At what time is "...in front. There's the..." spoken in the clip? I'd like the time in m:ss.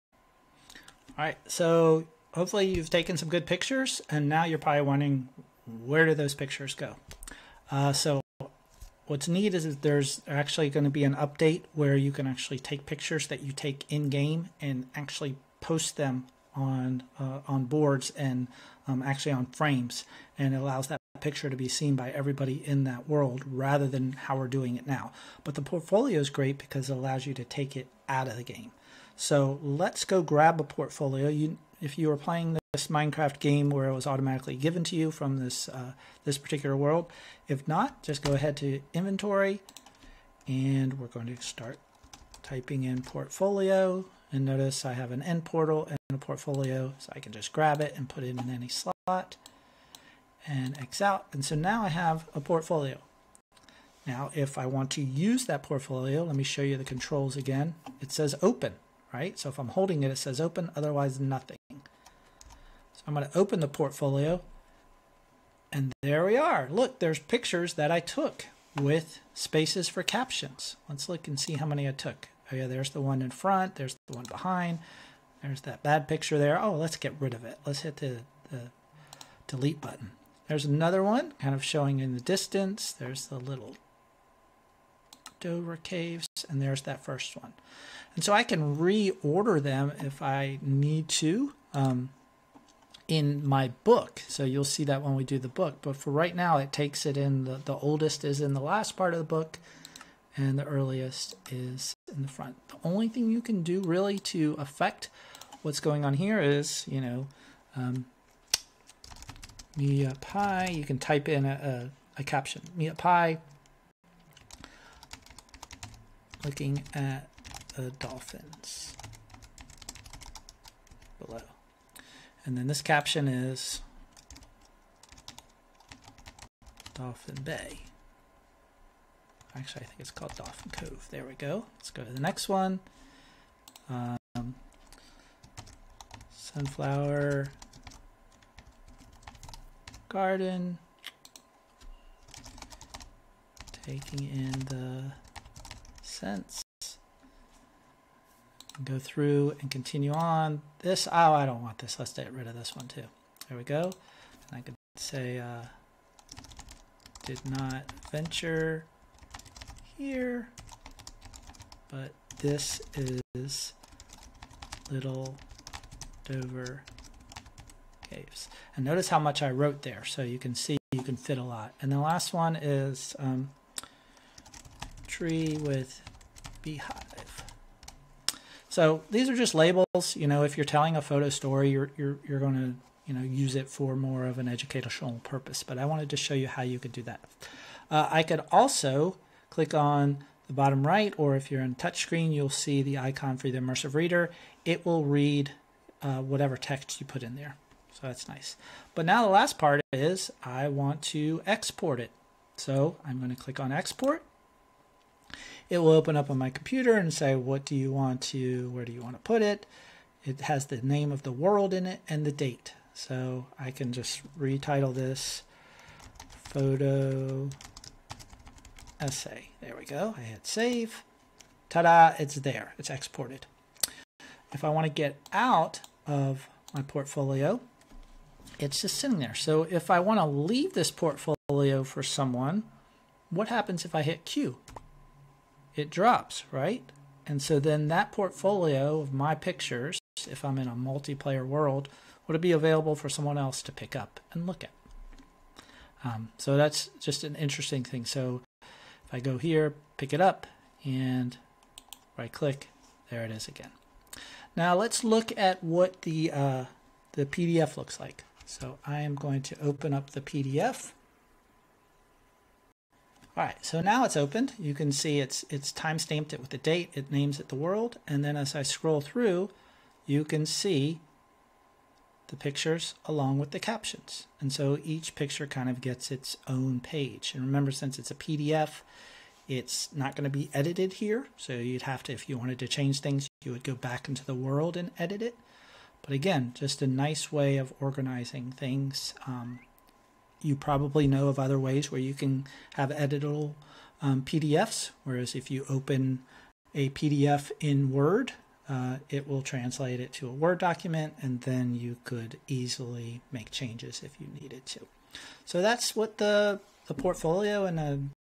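1:13.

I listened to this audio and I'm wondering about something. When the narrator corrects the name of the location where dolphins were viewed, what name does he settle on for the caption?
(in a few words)
Dolphin Cove.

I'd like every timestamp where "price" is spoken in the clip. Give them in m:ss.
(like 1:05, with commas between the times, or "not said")
not said.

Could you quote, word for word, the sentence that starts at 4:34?
And so each picture kind of gets its own page.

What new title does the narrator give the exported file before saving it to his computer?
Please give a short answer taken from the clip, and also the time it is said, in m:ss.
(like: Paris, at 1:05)
photo essay, at 3:36.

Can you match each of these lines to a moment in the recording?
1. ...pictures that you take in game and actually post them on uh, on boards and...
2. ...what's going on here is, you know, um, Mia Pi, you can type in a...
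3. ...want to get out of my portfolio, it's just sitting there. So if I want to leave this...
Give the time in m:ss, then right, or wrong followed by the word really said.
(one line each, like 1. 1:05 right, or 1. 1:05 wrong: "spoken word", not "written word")
1. 0:12 right
2. 1:45 right
3. 3:44 right.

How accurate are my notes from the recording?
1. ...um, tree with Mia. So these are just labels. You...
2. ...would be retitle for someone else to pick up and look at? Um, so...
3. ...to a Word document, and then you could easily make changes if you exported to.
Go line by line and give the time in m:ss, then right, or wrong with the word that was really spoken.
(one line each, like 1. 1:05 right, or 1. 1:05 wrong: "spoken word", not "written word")
1. 2:53 wrong: "Beehive", not "Mia"
2. 4:02 wrong: "available", not "retitle"
3. 5:00 wrong: "needed", not "exported".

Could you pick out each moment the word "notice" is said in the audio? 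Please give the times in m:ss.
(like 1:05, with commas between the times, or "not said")
0:44, 2:48.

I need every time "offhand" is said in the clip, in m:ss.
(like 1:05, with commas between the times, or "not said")
not said.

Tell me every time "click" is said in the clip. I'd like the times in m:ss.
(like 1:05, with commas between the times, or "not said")
3:09, 3:23, 4:12.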